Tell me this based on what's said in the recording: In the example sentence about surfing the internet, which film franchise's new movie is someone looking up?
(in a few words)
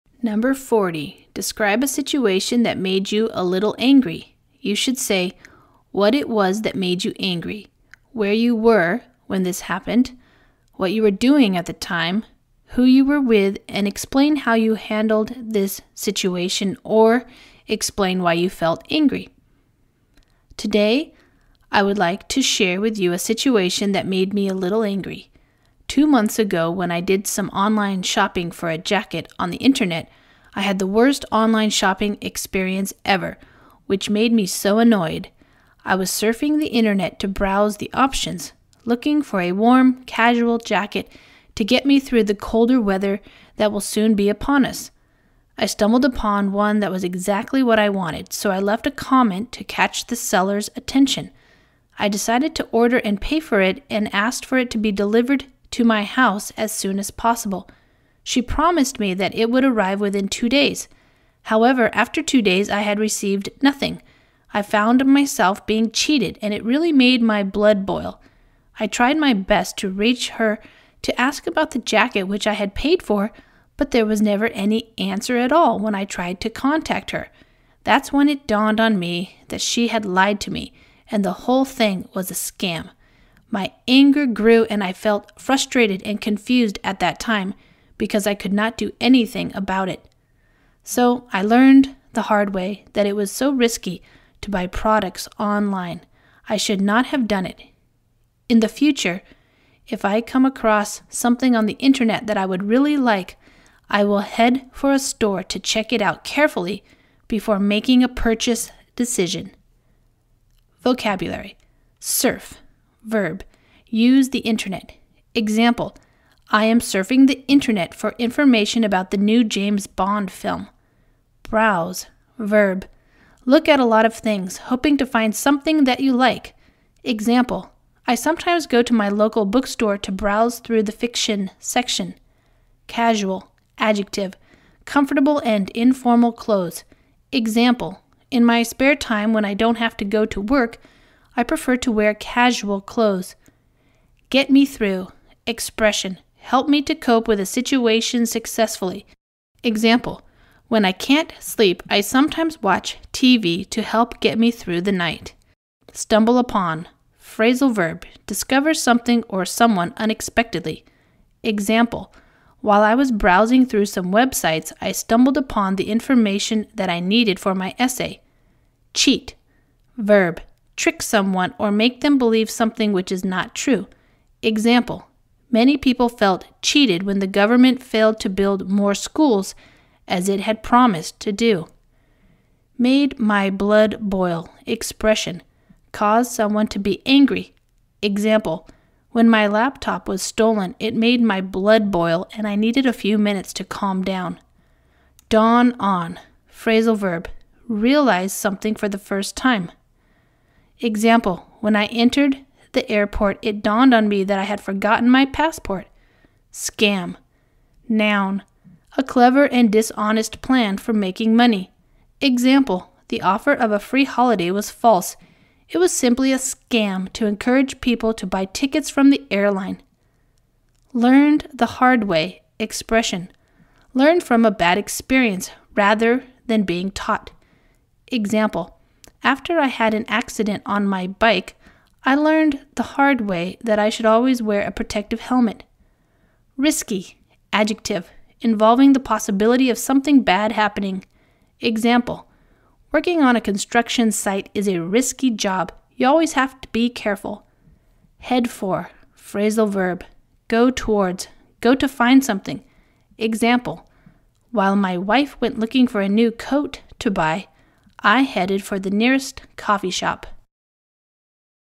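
James Bond.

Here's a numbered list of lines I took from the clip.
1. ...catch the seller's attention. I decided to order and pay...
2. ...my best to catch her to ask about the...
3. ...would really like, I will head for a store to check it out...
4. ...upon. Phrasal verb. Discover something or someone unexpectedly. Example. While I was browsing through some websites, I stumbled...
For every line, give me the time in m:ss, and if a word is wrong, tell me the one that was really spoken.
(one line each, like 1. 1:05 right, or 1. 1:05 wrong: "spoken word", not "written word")
1. 0:49 right
2. 1:09 wrong: "reach", not "catch"
3. 1:42 right
4. 2:36 right.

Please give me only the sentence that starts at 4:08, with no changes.
Head for, phrasal verb, go towards, go to find something.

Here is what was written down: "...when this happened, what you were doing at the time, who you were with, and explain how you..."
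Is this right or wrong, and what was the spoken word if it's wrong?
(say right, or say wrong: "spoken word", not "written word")
right.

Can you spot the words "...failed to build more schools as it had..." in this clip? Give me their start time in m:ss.
2:57.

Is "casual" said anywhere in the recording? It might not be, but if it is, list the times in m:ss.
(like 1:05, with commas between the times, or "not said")
0:40, 2:12, 2:22.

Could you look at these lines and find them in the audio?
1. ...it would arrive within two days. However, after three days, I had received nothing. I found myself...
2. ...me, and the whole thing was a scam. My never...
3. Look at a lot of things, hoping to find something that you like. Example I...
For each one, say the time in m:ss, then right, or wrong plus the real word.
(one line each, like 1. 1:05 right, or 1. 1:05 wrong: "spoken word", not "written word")
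1. 0:59 wrong: "two", not "three"
2. 1:20 wrong: "anger", not "never"
3. 2:03 right.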